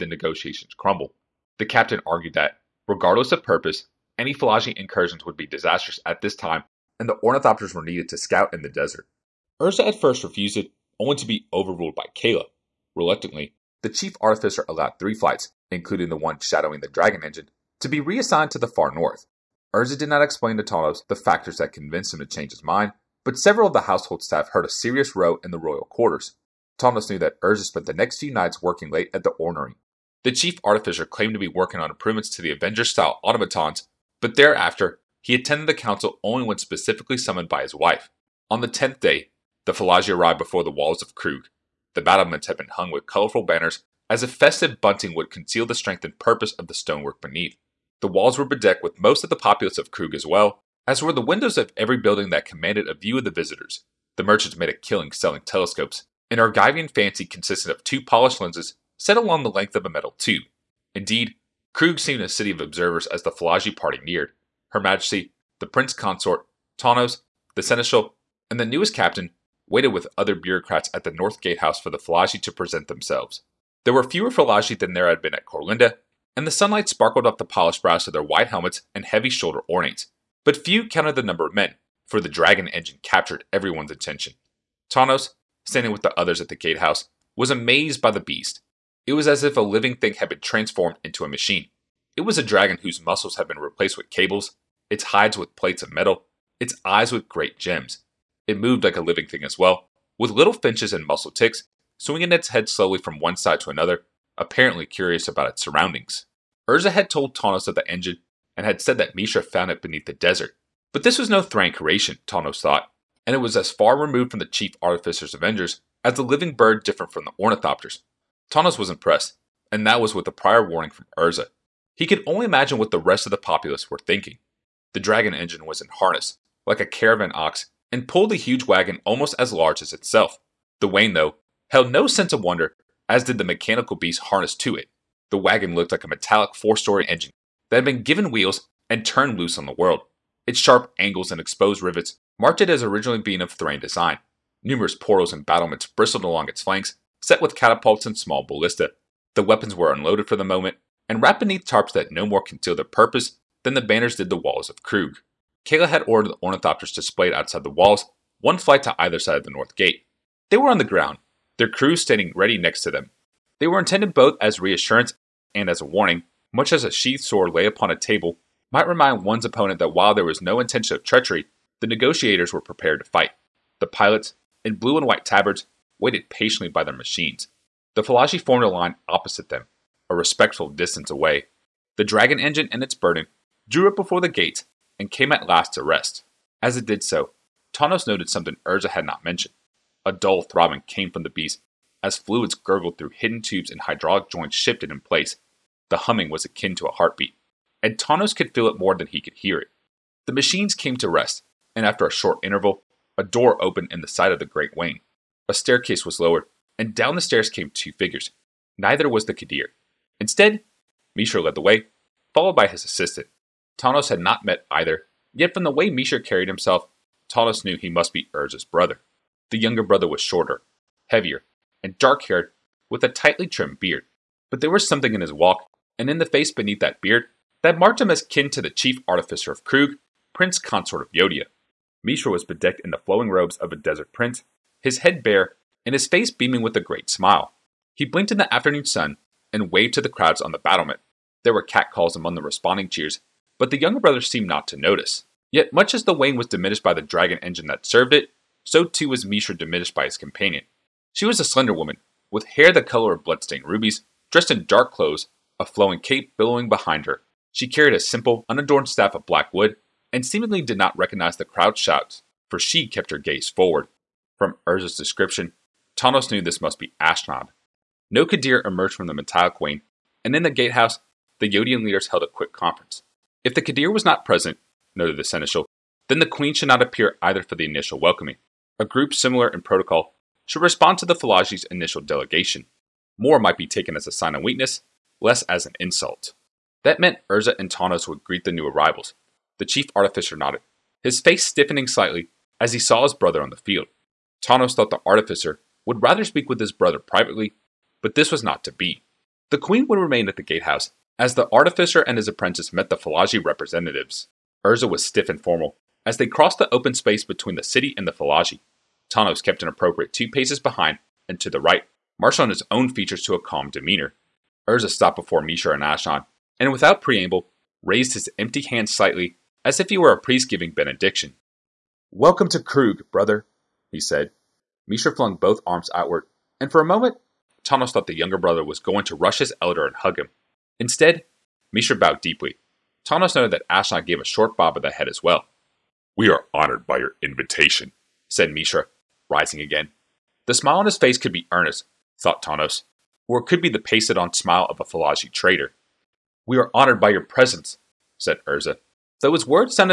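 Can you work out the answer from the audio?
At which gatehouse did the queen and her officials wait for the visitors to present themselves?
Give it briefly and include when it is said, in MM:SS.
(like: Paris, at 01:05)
North Gatehouse, at 01:11.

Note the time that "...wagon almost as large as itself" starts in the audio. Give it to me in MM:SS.
02:08.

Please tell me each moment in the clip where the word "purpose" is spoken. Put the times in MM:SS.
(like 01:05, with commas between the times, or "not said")
00:03, 00:46, 02:32.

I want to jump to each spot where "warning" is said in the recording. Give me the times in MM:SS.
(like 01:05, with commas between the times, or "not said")
02:00, 02:45.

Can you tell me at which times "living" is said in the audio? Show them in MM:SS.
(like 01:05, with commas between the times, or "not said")
01:29, 01:39, 01:56.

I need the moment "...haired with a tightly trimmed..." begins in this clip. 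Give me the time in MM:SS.
03:42.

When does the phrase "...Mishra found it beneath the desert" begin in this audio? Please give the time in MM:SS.
01:49.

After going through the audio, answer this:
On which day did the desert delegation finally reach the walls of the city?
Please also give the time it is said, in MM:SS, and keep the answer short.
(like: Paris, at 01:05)
10th day, at 00:38.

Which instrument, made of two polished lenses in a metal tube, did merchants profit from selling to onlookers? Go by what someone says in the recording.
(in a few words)
telescopes.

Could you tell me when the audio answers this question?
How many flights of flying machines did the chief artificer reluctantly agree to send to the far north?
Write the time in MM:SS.
00:14.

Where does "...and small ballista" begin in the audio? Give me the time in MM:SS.
02:28.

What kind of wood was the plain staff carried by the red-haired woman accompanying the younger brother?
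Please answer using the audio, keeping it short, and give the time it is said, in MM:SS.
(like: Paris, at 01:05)
black wood, at 04:19.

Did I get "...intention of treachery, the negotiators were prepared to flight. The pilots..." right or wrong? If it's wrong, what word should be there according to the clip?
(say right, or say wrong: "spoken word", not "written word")
wrong: "fight", not "flight".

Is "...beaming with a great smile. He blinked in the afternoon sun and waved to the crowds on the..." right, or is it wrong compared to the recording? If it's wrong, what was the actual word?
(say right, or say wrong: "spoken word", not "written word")
right.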